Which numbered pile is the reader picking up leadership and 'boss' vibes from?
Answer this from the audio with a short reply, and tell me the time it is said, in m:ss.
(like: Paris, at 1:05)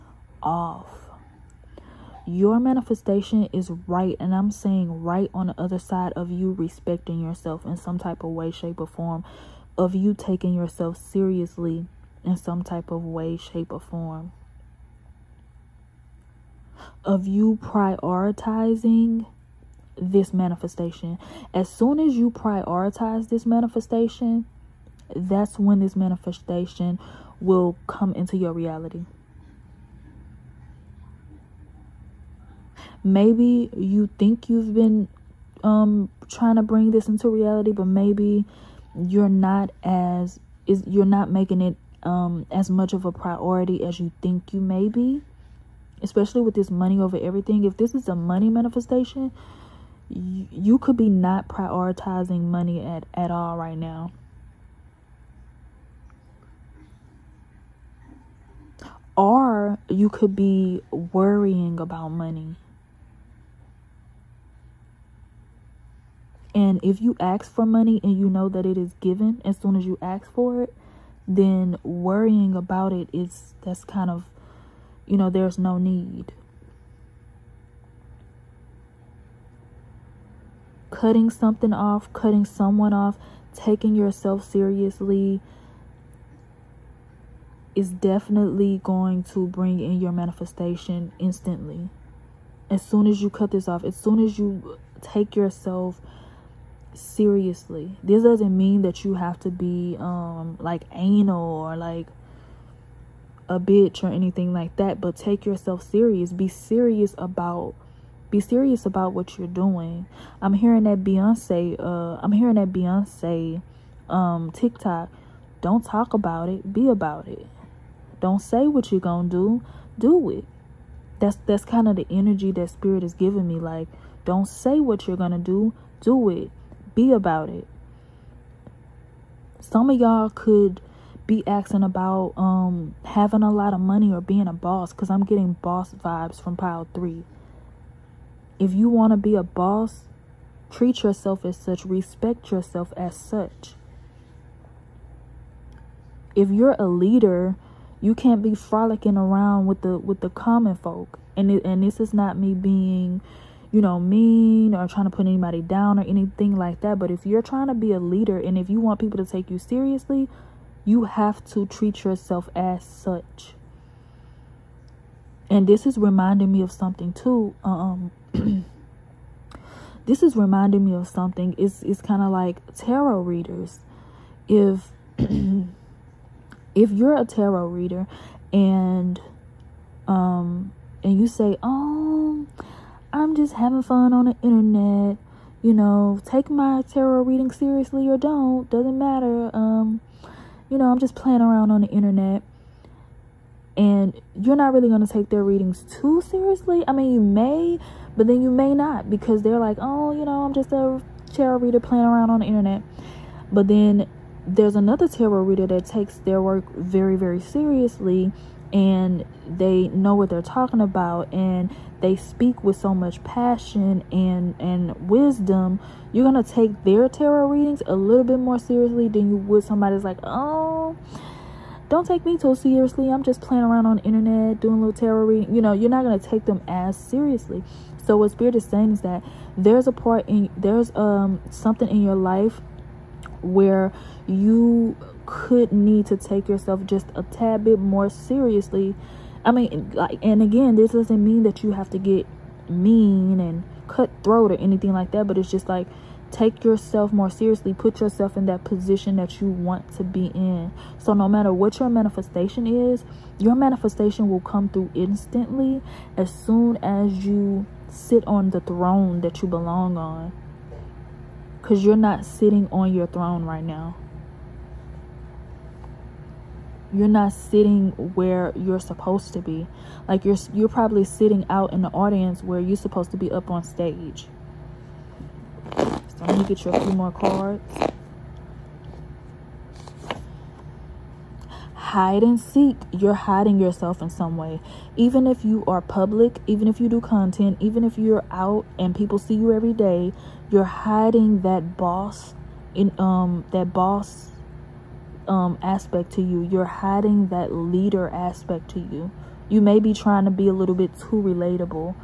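Pile three, at 2:16.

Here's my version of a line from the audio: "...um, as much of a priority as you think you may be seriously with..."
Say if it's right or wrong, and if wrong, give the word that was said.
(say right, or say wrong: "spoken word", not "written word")
wrong: "especially", not "seriously".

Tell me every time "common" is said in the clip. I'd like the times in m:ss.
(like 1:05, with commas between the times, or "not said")
2:30.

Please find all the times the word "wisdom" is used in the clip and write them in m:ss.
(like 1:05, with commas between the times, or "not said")
3:35.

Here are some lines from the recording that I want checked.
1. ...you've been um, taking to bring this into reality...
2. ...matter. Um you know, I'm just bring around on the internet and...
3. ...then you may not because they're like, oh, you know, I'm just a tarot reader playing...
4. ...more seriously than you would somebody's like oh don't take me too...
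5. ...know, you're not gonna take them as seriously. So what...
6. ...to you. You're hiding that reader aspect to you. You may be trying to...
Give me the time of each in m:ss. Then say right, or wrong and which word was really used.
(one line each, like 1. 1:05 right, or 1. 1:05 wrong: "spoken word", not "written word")
1. 0:34 wrong: "trying", not "taking"
2. 3:08 wrong: "playing", not "bring"
3. 3:18 right
4. 3:38 right
5. 3:45 right
6. 4:56 wrong: "leader", not "reader".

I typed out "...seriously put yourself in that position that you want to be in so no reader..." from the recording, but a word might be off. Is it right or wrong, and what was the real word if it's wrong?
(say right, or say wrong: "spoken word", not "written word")
wrong: "matter", not "reader".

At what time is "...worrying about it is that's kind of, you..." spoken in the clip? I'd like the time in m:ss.
1:11.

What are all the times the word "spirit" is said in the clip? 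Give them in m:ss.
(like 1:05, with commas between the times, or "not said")
2:02, 3:48.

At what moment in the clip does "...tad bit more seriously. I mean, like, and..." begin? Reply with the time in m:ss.
3:57.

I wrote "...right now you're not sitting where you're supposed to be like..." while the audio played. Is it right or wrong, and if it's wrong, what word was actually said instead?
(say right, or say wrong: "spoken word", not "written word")
right.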